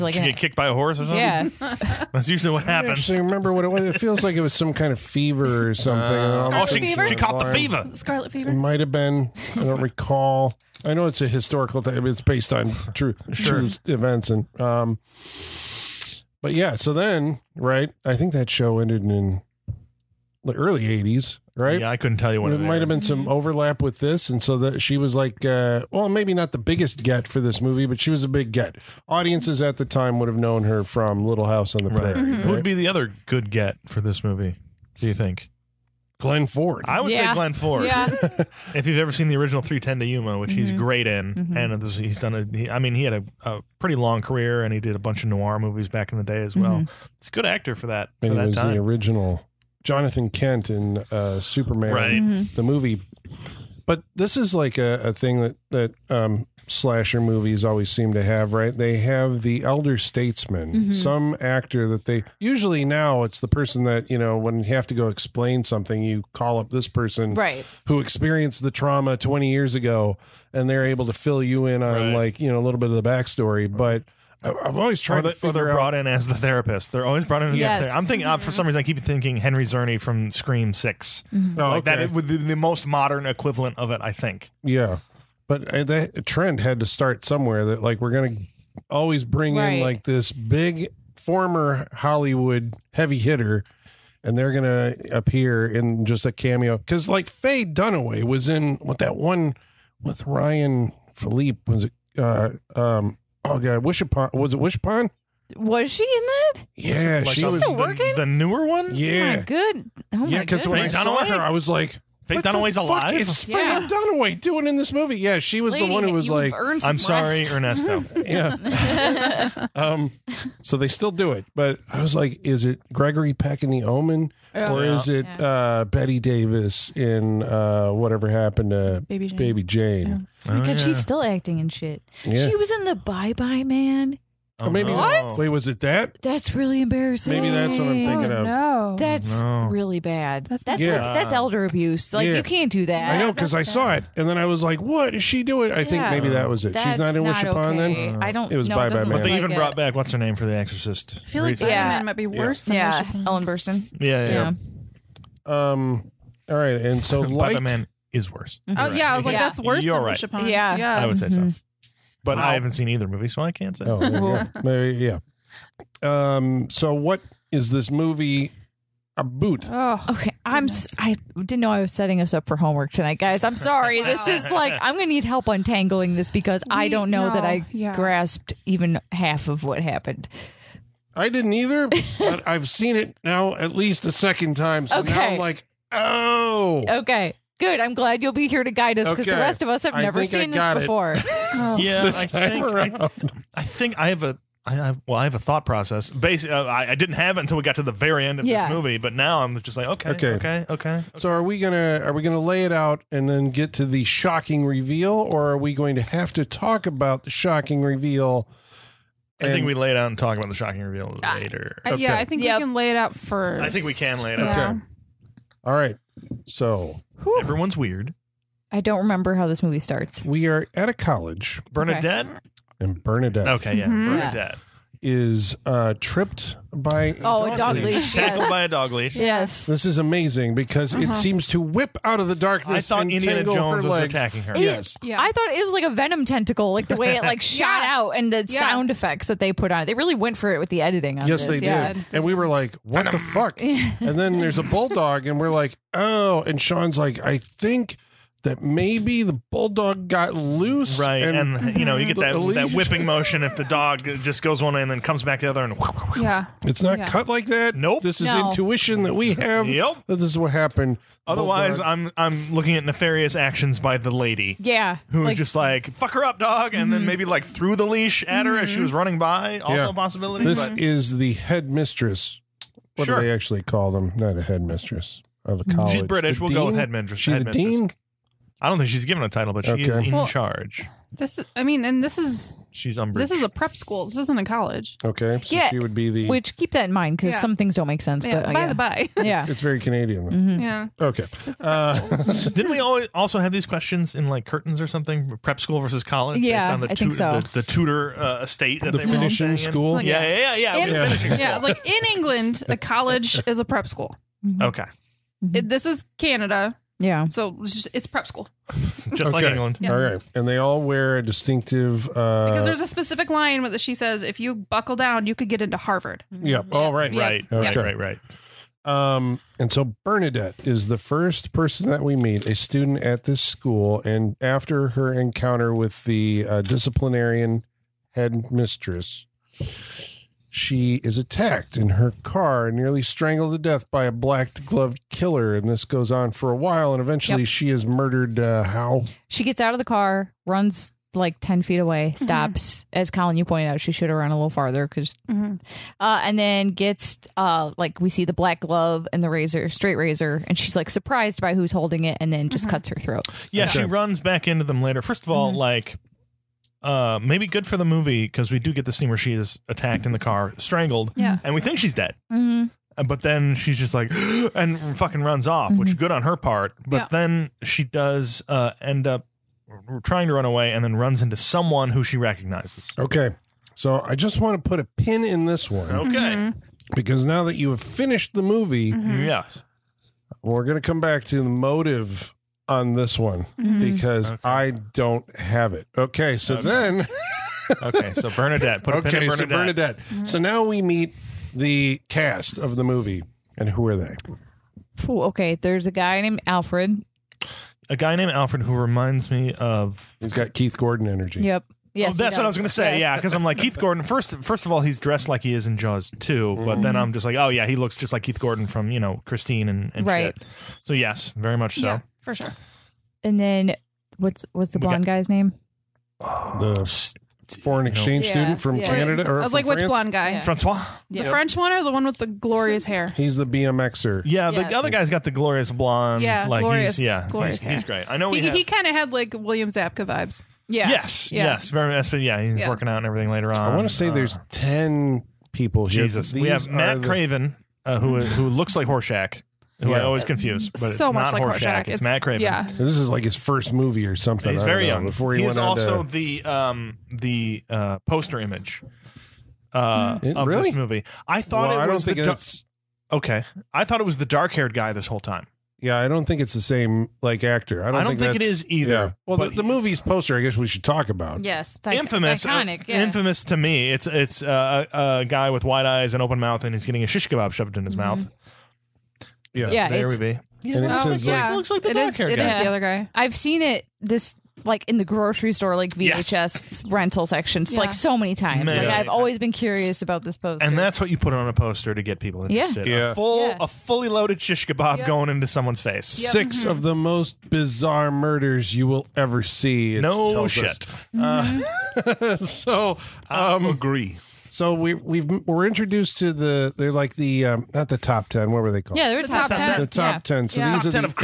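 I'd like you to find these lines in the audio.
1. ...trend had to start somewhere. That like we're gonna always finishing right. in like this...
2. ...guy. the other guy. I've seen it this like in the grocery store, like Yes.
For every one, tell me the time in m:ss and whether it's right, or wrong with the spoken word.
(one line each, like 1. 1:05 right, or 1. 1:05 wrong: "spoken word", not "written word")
1. 1:26 wrong: "bring", not "finishing"
2. 7:52 right.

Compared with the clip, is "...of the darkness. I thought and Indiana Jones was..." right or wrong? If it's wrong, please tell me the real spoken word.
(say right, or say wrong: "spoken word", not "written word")
right.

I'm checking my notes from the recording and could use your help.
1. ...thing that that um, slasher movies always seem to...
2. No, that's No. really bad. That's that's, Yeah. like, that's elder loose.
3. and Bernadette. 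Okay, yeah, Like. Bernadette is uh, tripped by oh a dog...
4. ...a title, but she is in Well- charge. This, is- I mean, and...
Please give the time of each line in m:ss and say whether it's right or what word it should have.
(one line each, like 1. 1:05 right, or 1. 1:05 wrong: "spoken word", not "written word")
1. 0:55 right
2. 2:18 wrong: "abuse", not "loose"
3. 3:42 wrong: "Mhm", not "Like"
4. 4:39 right.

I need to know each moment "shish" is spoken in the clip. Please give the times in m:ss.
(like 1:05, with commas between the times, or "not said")
7:47, 8:04.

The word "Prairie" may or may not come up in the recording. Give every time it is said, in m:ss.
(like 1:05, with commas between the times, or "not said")
0:31.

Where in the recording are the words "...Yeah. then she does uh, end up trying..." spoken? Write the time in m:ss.
6:06.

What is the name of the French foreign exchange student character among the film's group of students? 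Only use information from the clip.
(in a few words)
Francois.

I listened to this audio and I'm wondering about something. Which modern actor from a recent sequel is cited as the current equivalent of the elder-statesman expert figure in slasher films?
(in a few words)
Henry Czerny.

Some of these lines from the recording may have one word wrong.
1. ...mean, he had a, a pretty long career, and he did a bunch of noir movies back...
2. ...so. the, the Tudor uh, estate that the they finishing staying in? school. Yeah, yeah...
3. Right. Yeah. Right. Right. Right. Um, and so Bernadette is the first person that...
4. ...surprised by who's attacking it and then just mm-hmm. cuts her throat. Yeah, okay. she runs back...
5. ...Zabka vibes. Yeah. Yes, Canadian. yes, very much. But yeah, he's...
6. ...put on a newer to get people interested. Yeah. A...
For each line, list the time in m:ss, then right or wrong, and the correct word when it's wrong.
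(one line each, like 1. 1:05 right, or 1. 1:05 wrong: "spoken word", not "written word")
1. 0:42 right
2. 4:57 right
3. 5:17 right
4. 5:50 wrong: "holding", not "attacking"
5. 7:09 wrong: "Yeah", not "Canadian"
6. 8:01 wrong: "poster", not "newer".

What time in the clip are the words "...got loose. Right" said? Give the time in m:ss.
4:10.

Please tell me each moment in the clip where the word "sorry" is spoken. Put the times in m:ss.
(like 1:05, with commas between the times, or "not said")
1:56, 2:53.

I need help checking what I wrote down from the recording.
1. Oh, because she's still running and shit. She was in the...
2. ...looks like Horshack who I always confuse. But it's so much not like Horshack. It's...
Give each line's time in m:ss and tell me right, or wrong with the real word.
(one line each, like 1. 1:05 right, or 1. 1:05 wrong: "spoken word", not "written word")
1. 2:10 wrong: "acting", not "running"
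2. 7:18 right.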